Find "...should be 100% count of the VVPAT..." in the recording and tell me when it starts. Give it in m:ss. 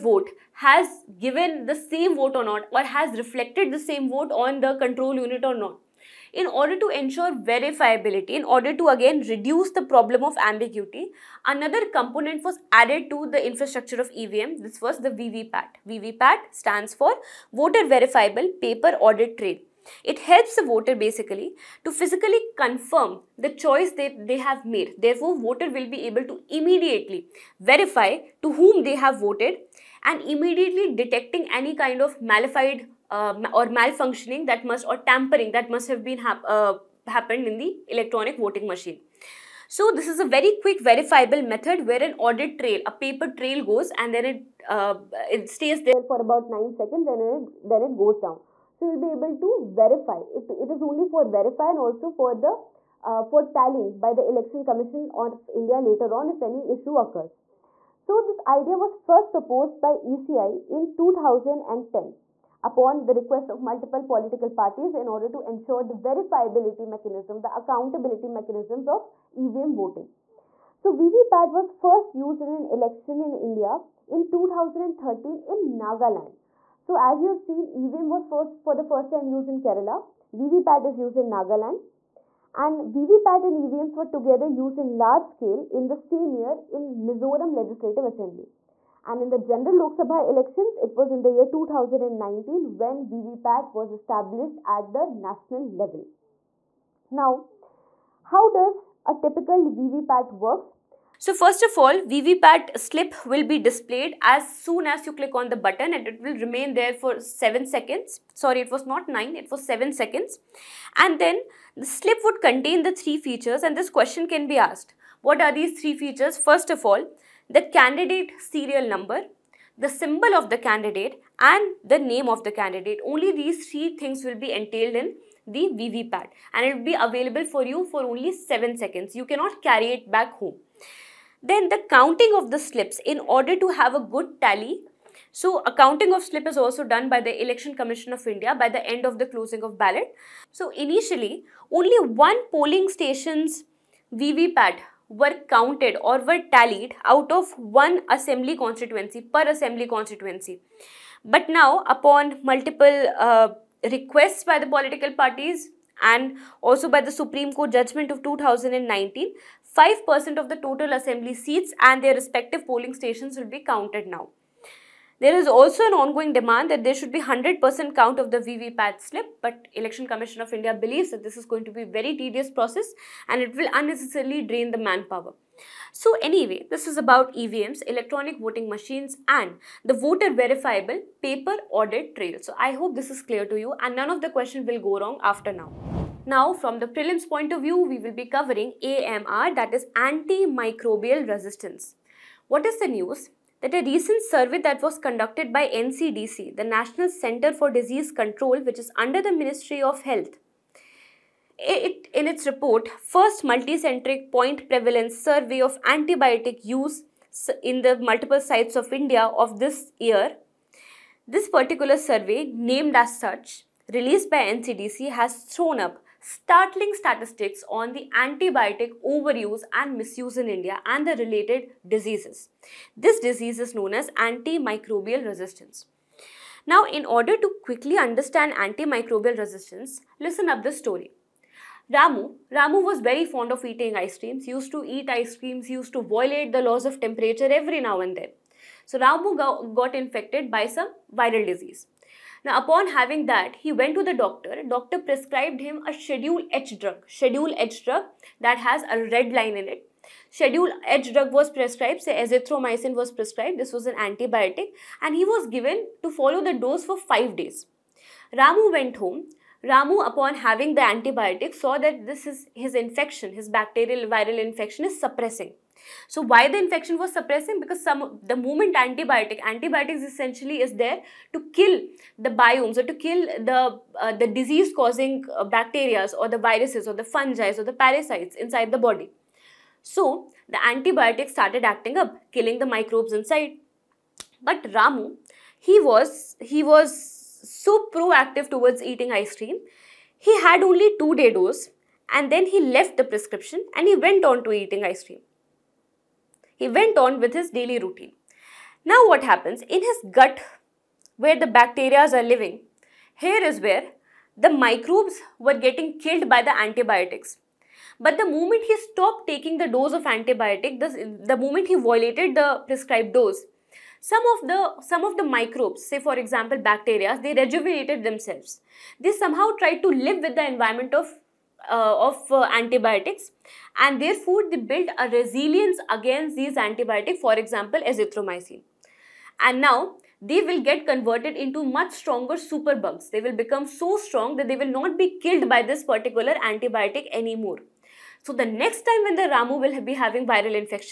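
2:46.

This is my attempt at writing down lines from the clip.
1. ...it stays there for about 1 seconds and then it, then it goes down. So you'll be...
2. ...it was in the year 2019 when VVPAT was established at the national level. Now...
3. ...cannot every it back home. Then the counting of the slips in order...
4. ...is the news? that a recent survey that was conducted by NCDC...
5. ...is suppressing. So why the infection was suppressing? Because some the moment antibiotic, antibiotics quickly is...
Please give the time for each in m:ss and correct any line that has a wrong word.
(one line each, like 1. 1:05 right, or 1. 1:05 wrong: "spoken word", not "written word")
1. 0:45 wrong: "9", not "1"
2. 1:30 right
3. 2:09 wrong: "carry", not "every"
4. 3:12 right
5. 4:24 wrong: "essentially", not "quickly".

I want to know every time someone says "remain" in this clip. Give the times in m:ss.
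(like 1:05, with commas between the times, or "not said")
1:46.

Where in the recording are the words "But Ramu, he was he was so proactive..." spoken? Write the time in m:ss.
4:44.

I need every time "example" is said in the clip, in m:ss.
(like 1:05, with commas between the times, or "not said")
5:16, 5:27.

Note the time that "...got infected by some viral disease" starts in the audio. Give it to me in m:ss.
3:59.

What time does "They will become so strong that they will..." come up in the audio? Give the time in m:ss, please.
5:33.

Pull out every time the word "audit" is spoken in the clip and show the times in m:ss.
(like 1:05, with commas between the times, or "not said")
0:18, 0:42, 3:01.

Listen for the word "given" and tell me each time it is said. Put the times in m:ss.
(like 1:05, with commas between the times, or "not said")
0:01, 4:15.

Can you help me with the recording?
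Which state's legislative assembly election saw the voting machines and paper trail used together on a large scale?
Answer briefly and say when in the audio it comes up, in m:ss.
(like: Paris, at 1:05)
Mizoram, at 1:27.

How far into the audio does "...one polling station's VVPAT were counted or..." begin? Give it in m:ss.
2:22.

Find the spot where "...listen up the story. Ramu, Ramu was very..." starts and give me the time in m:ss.
3:50.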